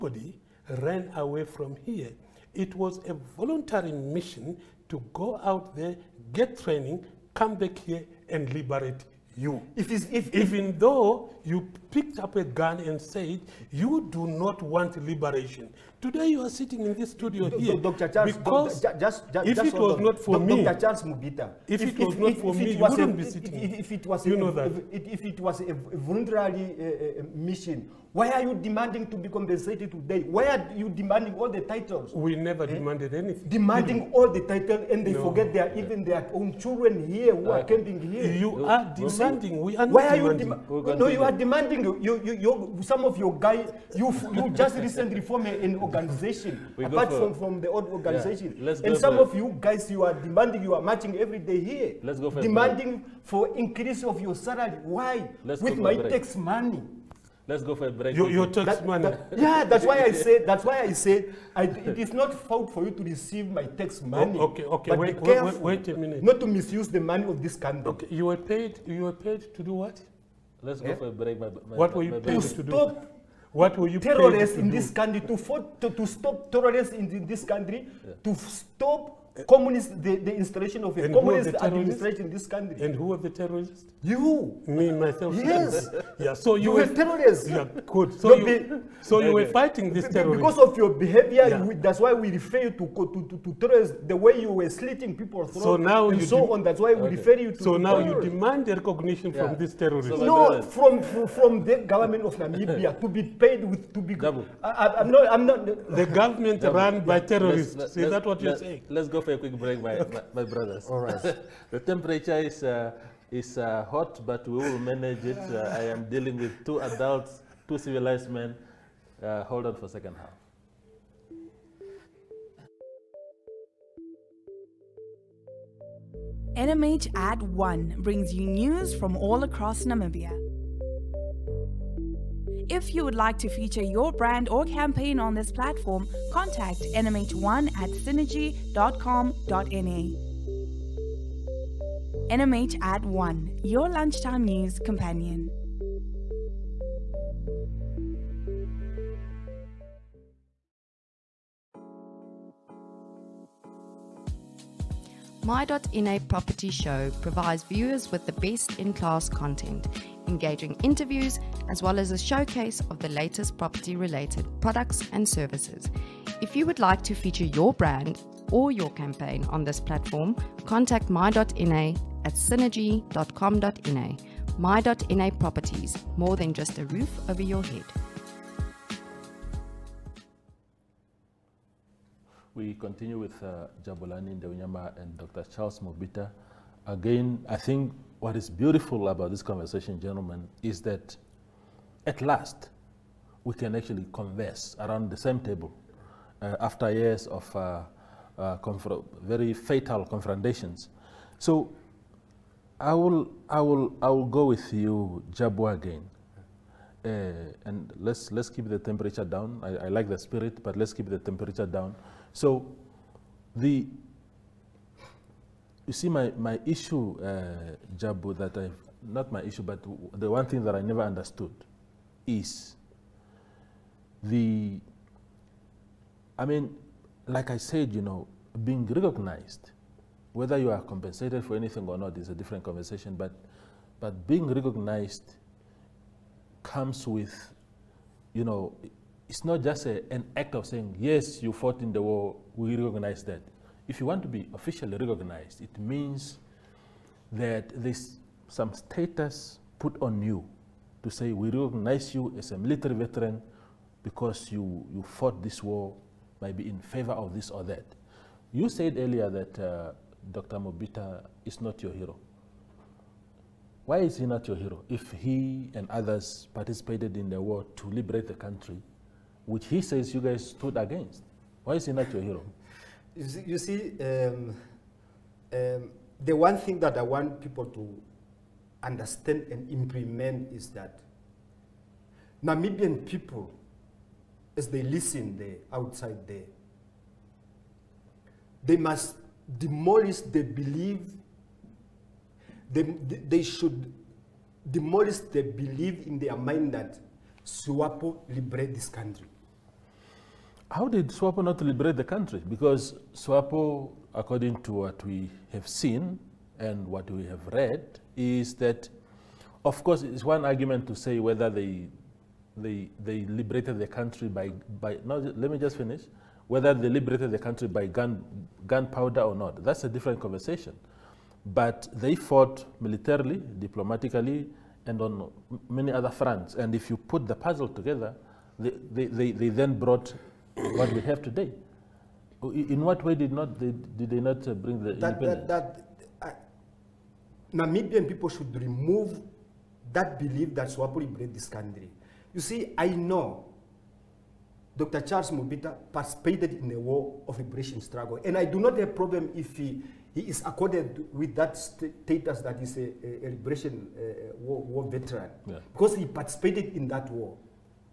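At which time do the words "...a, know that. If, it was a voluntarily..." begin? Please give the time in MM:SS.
00:24.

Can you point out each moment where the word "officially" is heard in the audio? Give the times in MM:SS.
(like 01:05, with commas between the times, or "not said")
04:04.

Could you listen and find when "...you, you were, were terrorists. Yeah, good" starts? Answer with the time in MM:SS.
01:26.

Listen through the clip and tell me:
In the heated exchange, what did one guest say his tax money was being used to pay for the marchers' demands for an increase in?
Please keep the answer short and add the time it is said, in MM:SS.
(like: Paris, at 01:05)
Salary, at 00:54.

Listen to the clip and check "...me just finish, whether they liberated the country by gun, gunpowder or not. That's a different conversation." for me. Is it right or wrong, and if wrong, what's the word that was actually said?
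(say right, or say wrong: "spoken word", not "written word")
right.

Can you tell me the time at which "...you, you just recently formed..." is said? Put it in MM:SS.
00:43.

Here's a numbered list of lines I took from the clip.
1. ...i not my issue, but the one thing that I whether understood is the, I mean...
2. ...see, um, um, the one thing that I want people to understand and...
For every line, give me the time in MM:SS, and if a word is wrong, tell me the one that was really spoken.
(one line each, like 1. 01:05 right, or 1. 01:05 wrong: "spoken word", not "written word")
1. 03:38 wrong: "never", not "whether"
2. 04:33 right.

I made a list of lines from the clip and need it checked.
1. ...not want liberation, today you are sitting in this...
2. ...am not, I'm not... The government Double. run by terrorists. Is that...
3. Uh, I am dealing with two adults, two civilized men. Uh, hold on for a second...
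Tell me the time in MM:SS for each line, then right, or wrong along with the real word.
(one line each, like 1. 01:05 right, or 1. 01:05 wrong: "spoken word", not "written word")
1. 00:14 right
2. 01:44 right
3. 01:55 right.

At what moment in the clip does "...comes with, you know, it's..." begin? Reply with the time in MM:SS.
03:56.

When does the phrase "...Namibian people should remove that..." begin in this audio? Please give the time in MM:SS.
05:37.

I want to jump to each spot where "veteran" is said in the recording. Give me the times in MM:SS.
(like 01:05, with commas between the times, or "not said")
04:12, 05:54.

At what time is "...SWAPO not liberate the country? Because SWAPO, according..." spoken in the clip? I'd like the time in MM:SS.
05:01.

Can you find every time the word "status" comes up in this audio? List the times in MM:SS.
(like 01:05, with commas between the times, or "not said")
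04:08, 05:51.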